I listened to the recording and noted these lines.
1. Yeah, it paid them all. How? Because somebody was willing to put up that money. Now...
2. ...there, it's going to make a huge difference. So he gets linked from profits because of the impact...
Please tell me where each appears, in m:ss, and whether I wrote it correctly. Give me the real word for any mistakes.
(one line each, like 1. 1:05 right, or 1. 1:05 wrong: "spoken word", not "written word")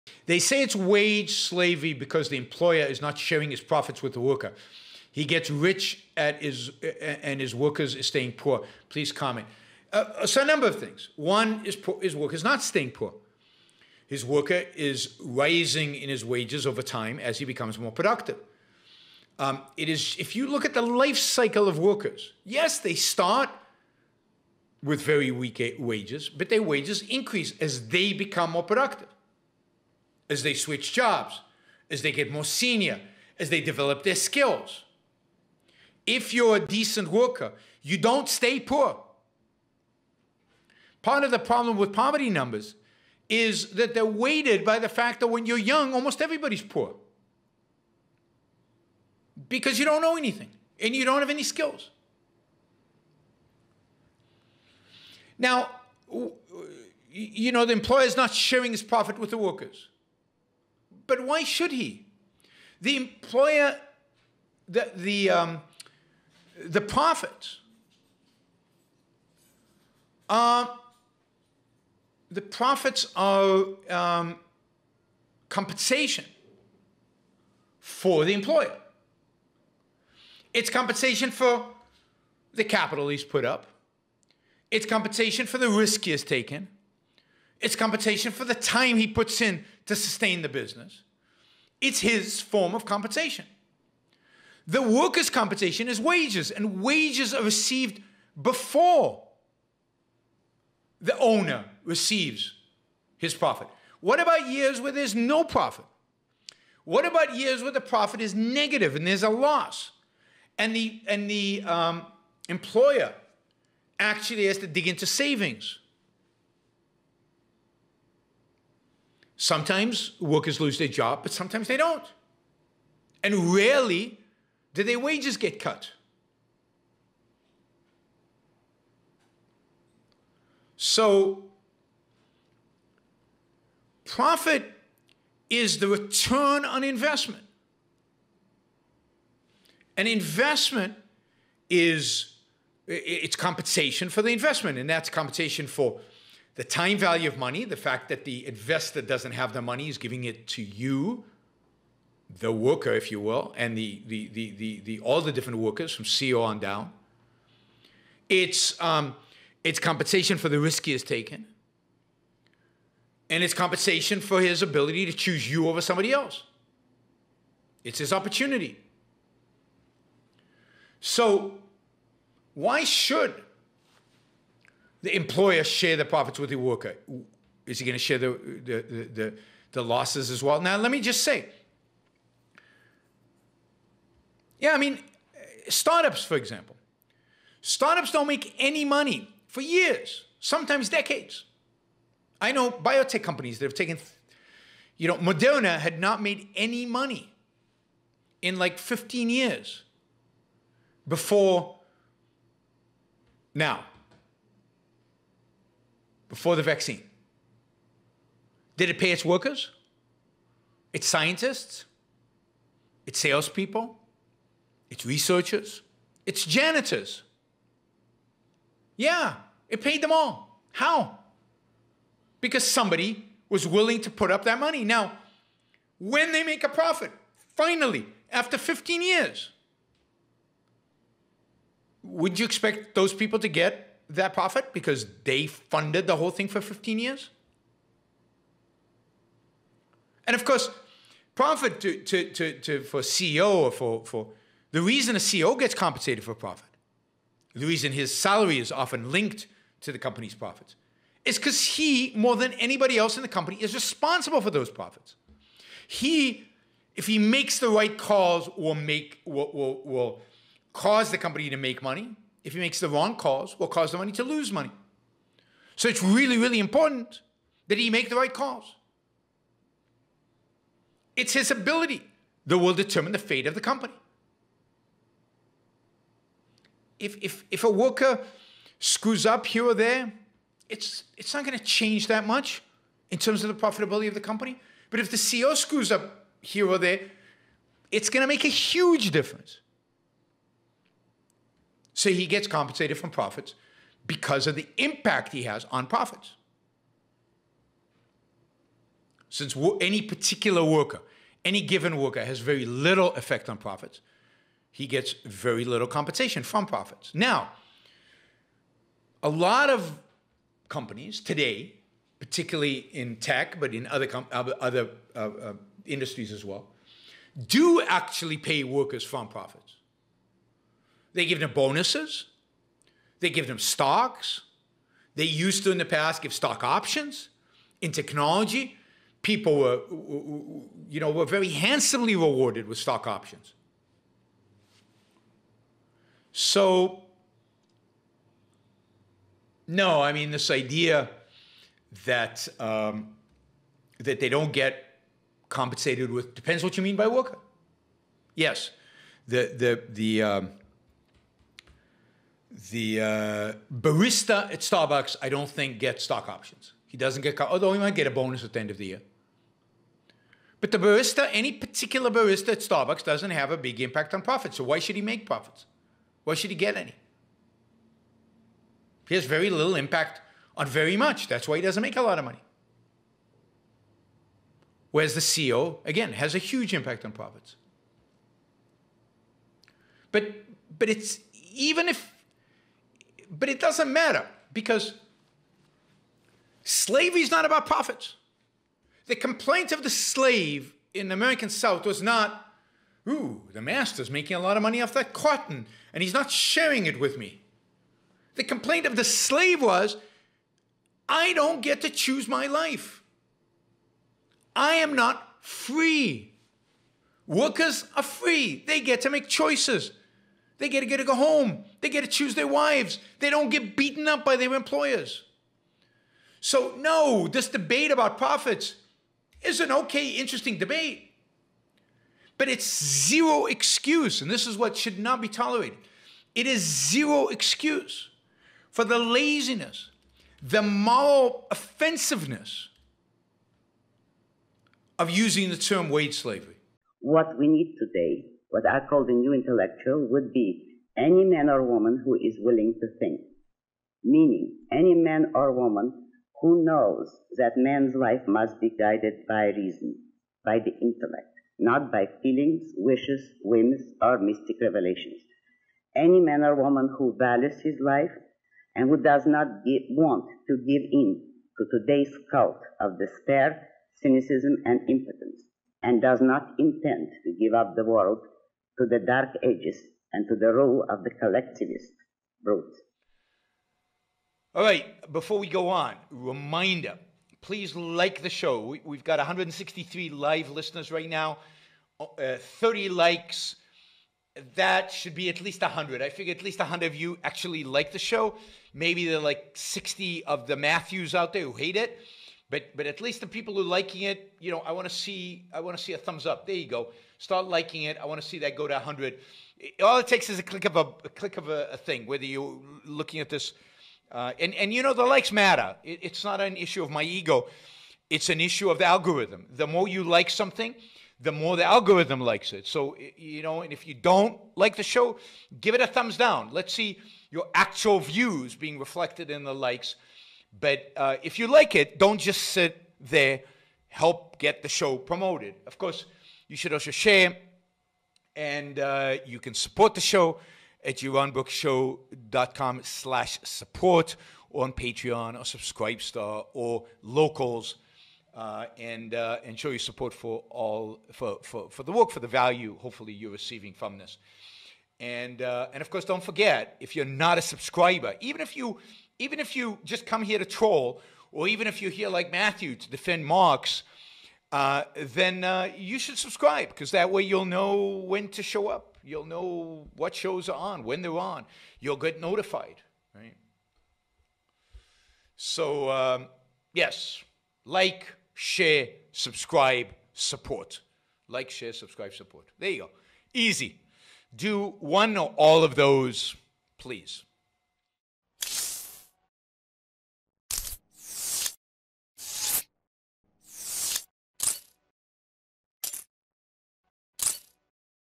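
1. 3:38 right
2. 4:46 wrong: "compensated", not "linked".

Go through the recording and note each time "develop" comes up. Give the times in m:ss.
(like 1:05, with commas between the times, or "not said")
0:33.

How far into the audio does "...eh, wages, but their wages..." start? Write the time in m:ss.
0:25.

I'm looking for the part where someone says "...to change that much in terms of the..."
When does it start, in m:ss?
4:41.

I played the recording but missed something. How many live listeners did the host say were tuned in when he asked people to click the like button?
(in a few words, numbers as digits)
163.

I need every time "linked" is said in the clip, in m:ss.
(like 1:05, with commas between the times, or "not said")
4:09.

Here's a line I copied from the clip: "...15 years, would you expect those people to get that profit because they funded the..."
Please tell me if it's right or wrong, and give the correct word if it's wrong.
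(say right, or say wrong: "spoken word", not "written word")
right.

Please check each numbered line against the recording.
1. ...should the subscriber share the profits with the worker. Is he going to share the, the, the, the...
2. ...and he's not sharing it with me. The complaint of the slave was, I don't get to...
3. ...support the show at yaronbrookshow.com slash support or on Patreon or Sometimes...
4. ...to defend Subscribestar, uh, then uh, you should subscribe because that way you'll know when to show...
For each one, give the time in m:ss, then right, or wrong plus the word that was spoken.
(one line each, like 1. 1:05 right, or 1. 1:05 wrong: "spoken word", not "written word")
1. 2:52 wrong: "employer", not "subscriber"
2. 6:35 right
3. 8:49 wrong: "Subscribestar", not "Sometimes"
4. 9:12 wrong: "Marx", not "Subscribestar".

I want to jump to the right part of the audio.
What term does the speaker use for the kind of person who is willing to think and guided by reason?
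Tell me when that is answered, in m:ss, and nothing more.
7:19.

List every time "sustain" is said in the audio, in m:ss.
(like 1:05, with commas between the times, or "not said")
1:29.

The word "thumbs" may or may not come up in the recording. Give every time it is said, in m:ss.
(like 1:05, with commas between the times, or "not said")
8:15, 8:35.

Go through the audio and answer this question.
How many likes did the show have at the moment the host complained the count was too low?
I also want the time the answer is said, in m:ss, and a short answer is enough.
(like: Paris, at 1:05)
30, at 8:02.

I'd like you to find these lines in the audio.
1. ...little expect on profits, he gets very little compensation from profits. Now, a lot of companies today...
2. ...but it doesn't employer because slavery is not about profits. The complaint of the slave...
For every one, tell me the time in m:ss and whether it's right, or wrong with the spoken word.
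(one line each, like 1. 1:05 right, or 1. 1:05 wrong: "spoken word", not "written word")
1. 5:02 wrong: "effect", not "expect"
2. 6:23 wrong: "matter", not "employer".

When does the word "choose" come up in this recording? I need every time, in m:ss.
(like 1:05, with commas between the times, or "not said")
2:45, 6:41, 6:52.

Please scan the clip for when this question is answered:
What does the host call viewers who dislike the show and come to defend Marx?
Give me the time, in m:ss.
8:10.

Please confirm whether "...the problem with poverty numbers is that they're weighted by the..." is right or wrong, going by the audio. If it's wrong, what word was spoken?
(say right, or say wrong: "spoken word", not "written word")
right.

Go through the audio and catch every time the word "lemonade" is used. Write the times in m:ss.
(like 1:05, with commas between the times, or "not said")
not said.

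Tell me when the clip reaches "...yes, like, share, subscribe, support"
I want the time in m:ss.
9:26.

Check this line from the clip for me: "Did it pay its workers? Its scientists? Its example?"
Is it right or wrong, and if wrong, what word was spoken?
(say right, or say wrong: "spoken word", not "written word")
wrong: "salespeople", not "example".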